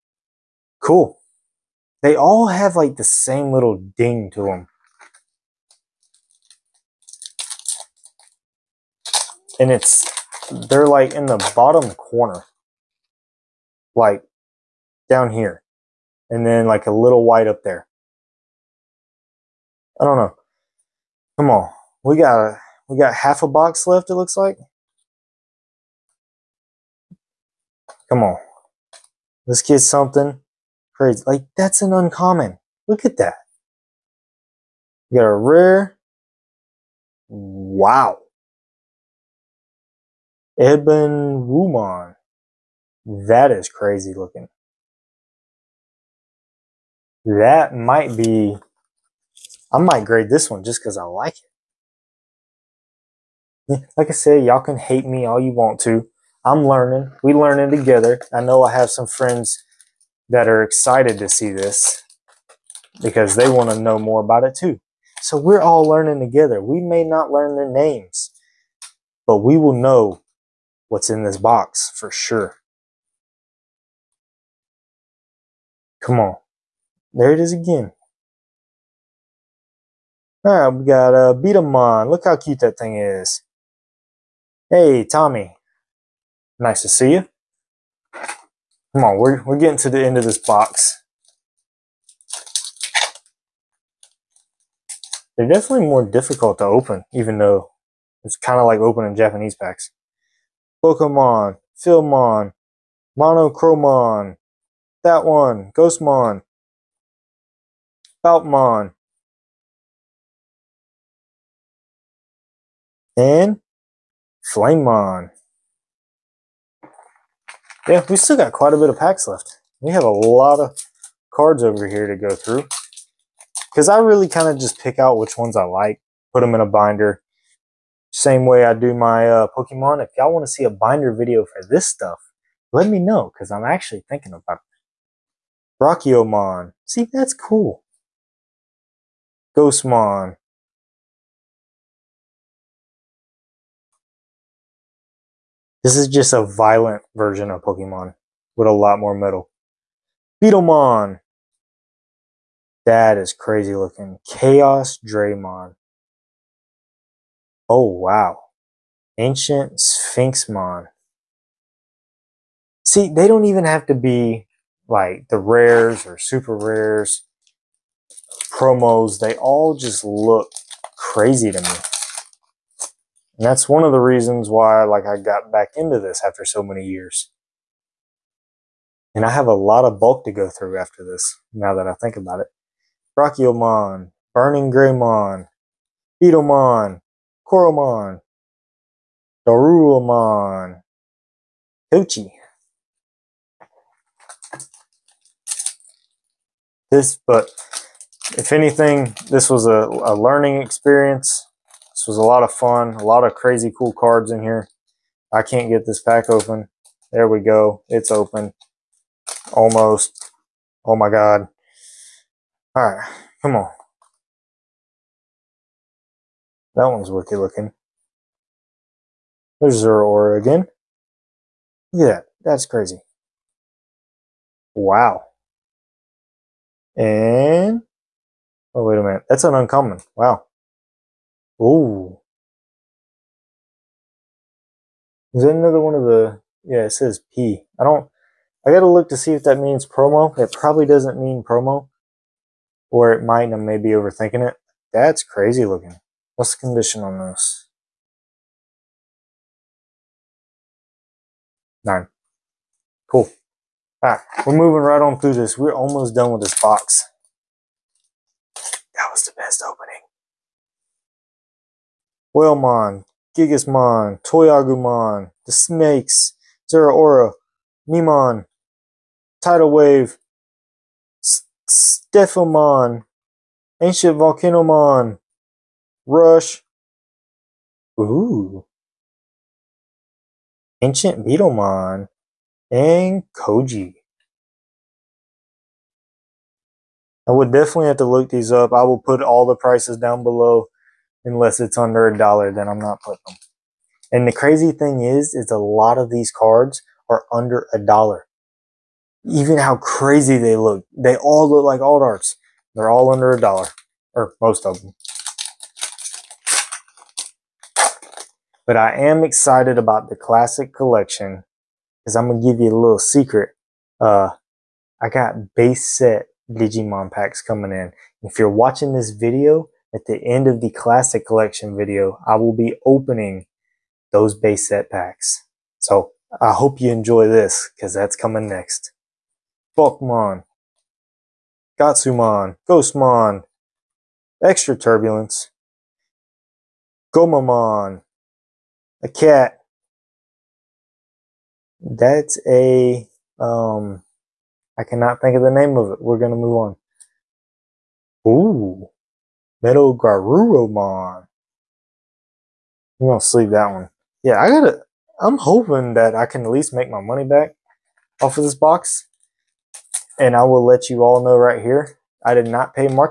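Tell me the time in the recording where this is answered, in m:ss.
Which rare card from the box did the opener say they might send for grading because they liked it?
0:40.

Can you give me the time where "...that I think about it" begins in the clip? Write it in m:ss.
3:01.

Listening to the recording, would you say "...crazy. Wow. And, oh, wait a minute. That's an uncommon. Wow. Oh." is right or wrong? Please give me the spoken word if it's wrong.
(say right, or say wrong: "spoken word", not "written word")
right.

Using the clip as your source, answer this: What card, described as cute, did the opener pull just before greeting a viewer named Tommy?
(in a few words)
Betamon.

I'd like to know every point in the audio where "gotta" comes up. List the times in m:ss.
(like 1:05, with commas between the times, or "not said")
3:58, 5:54.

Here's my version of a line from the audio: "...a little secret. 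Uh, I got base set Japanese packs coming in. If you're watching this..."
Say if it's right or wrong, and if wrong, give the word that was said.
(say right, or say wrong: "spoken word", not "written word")
wrong: "Digimon", not "Japanese".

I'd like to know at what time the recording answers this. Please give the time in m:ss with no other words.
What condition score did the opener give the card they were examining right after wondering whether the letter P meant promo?
4:11.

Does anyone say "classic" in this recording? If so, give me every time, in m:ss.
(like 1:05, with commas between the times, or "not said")
5:10, 5:20.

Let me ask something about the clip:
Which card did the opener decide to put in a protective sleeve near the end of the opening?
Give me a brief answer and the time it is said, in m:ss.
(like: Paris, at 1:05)
Metal Garurumon, at 5:49.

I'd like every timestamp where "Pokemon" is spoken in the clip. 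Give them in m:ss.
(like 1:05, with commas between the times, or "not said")
1:40, 2:09, 2:27.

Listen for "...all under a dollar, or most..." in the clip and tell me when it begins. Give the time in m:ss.
5:02.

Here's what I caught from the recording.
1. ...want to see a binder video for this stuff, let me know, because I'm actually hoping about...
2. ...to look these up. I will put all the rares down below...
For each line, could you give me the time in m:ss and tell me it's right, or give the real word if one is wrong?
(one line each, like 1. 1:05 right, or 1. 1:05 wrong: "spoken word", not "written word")
1. 2:10 wrong: "thinking", not "hoping"
2. 4:47 wrong: "prices", not "rares".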